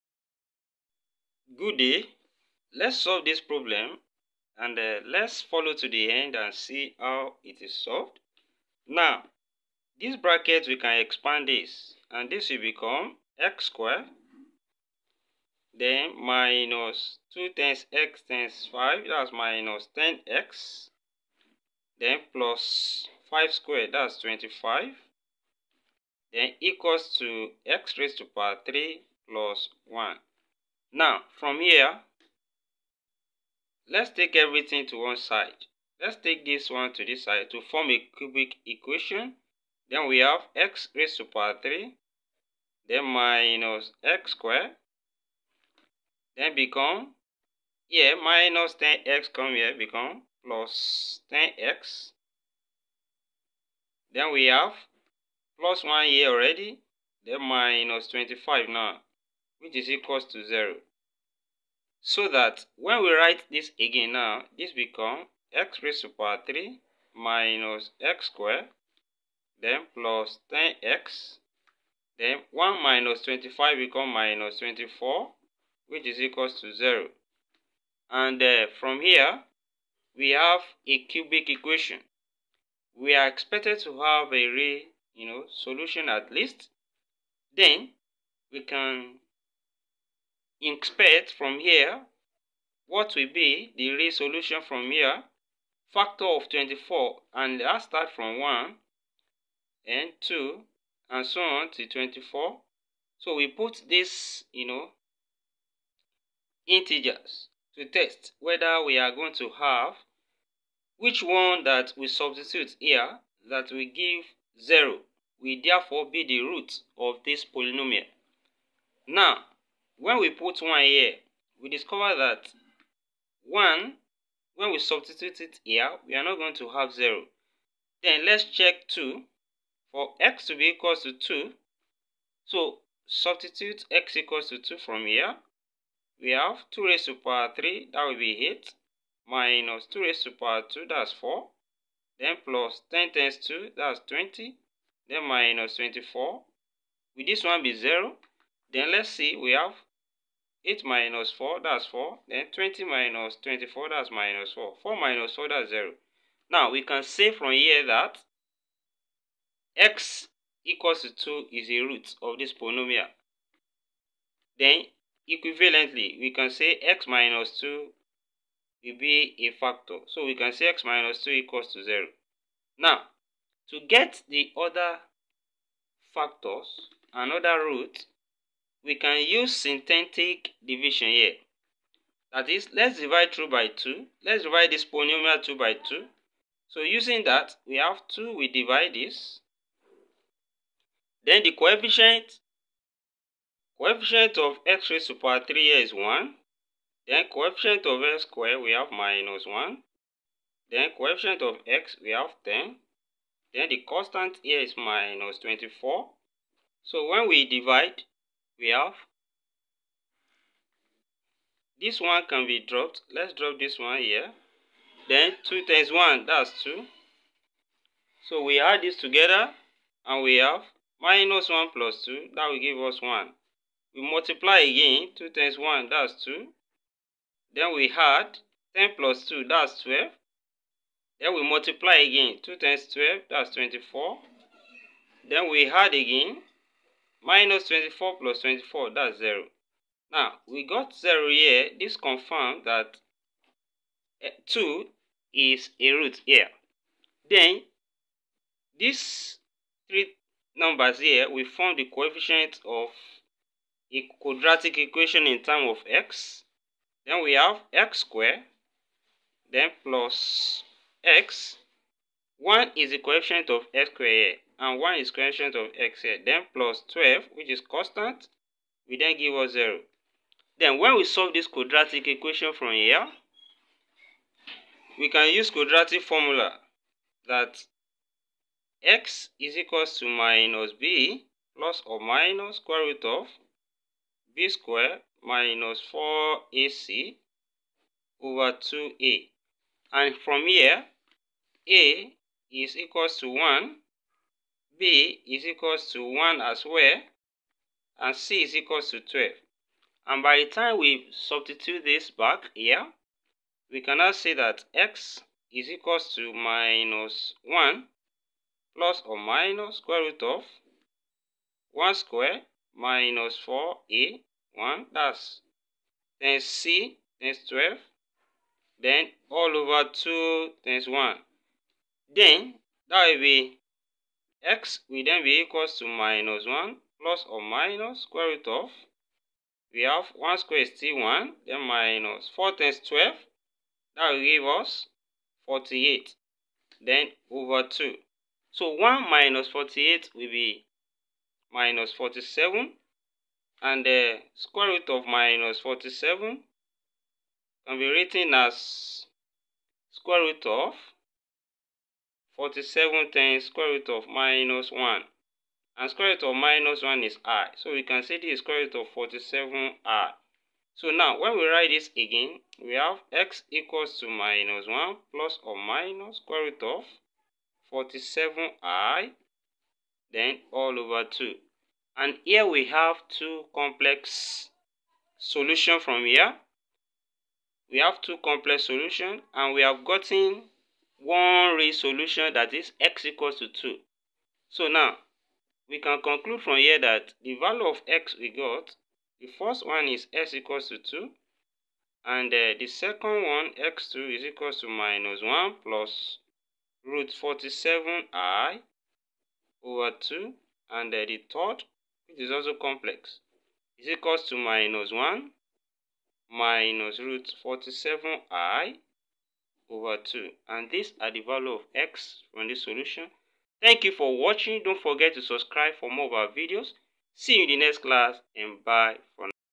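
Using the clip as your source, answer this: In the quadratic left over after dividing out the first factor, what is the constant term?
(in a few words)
12.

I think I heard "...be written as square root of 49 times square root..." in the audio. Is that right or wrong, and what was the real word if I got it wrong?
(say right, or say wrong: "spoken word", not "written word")
wrong: "47", not "49".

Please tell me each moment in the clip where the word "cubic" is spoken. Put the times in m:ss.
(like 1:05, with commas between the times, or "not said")
0:38, 1:21.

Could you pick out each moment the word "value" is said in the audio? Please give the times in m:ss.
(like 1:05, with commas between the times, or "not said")
6:27, 6:51.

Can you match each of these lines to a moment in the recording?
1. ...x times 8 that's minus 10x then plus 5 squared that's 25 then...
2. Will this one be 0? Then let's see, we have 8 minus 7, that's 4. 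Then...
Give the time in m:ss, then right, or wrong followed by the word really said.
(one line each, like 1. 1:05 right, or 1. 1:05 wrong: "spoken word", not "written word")
1. 0:17 wrong: "5", not "8"
2. 2:27 wrong: "4", not "7".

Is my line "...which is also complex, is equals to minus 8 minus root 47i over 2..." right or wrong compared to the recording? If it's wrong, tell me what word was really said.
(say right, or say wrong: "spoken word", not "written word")
wrong: "1", not "8".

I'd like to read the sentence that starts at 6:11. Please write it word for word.
And here we have two complex solution from here.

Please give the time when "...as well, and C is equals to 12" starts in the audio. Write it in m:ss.
4:56.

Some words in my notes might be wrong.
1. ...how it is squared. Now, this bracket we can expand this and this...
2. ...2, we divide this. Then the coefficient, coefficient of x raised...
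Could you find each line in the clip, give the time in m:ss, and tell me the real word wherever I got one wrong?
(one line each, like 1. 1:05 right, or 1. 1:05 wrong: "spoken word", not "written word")
1. 0:06 wrong: "solved", not "squared"
2. 3:08 right.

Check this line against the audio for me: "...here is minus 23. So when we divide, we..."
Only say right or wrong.
wrong.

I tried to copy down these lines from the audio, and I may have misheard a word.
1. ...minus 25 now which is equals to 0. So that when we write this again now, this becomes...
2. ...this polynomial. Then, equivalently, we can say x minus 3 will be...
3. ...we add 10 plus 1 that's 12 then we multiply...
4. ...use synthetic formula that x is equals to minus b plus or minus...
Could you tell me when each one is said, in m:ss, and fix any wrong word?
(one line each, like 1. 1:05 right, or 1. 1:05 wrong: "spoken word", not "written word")
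1. 0:57 right
2. 2:42 wrong: "2", not "3"
3. 3:47 wrong: "2", not "1"
4. 4:35 wrong: "quadratic", not "synthetic".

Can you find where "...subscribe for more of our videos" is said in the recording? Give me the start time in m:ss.
6:55.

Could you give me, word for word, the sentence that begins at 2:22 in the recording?
Then plus 10 times 2, that's 20.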